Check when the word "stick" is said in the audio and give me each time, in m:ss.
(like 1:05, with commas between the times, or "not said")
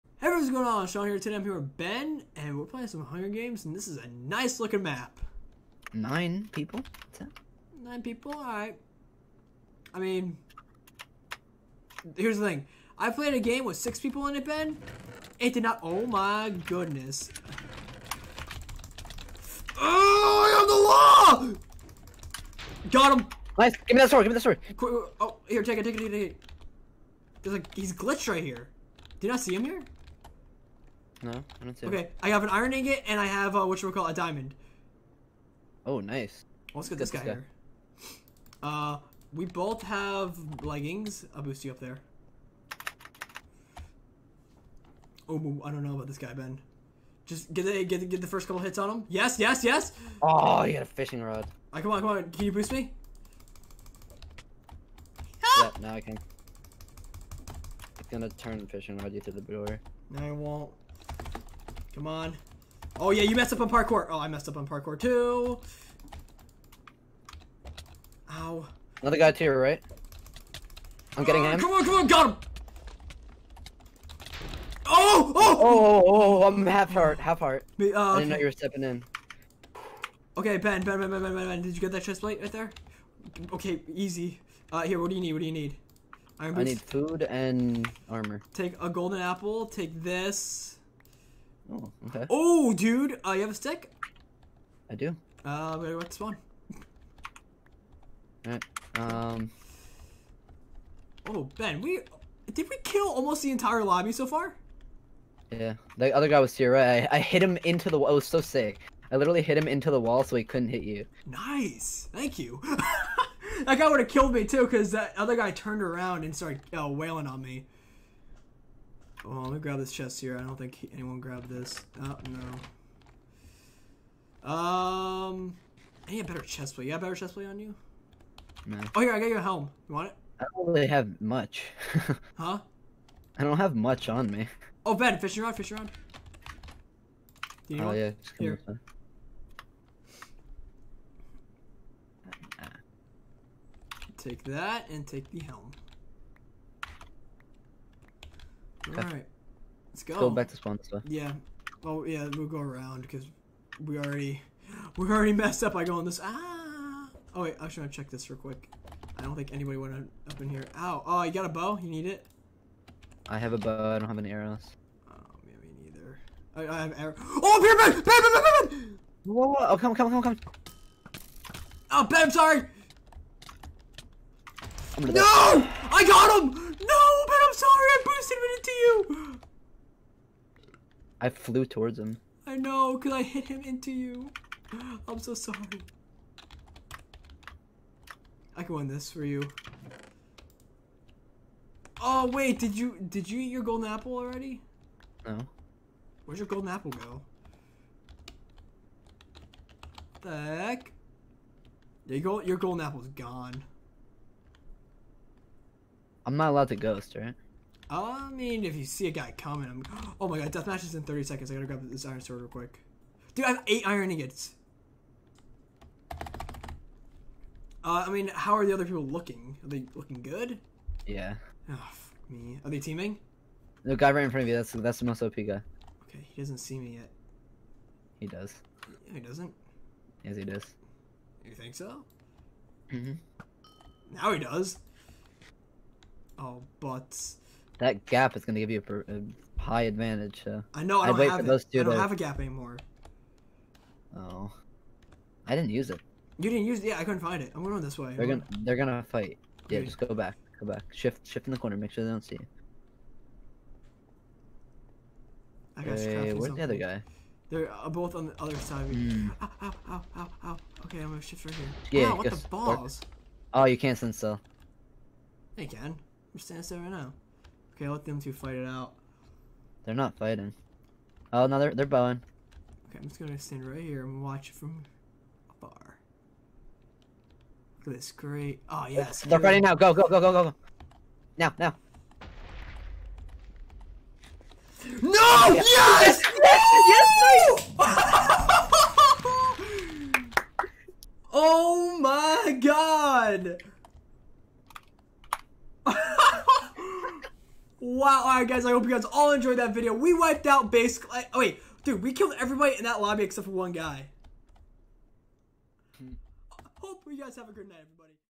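1:33.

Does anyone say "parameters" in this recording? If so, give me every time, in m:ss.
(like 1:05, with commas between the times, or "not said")
not said.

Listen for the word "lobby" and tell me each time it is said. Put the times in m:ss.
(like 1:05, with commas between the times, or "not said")
1:43, 5:02.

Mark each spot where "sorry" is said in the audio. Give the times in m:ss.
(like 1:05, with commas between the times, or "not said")
2:52, 2:57, 3:05.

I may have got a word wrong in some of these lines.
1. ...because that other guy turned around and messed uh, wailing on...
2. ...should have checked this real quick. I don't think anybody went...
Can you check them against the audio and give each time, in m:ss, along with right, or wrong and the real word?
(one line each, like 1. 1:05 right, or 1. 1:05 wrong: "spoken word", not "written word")
1. 1:54 wrong: "started", not "messed"
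2. 2:37 right.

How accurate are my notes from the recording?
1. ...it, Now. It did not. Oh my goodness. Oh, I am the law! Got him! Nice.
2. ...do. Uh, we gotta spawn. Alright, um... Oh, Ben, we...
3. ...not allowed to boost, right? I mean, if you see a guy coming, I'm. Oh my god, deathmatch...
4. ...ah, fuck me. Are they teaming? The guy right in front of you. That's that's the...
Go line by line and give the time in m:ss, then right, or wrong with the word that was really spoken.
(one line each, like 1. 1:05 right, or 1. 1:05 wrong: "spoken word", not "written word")
1. 0:14 wrong: "Ben", not "Now"
2. 1:34 right
3. 3:26 wrong: "ghost", not "boost"
4. 3:41 right.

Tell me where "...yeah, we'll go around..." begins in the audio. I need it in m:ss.
2:32.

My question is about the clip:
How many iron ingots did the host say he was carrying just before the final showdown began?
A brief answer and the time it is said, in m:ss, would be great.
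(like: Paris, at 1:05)
8, at 3:33.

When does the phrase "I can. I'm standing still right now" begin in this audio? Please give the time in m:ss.
4:25.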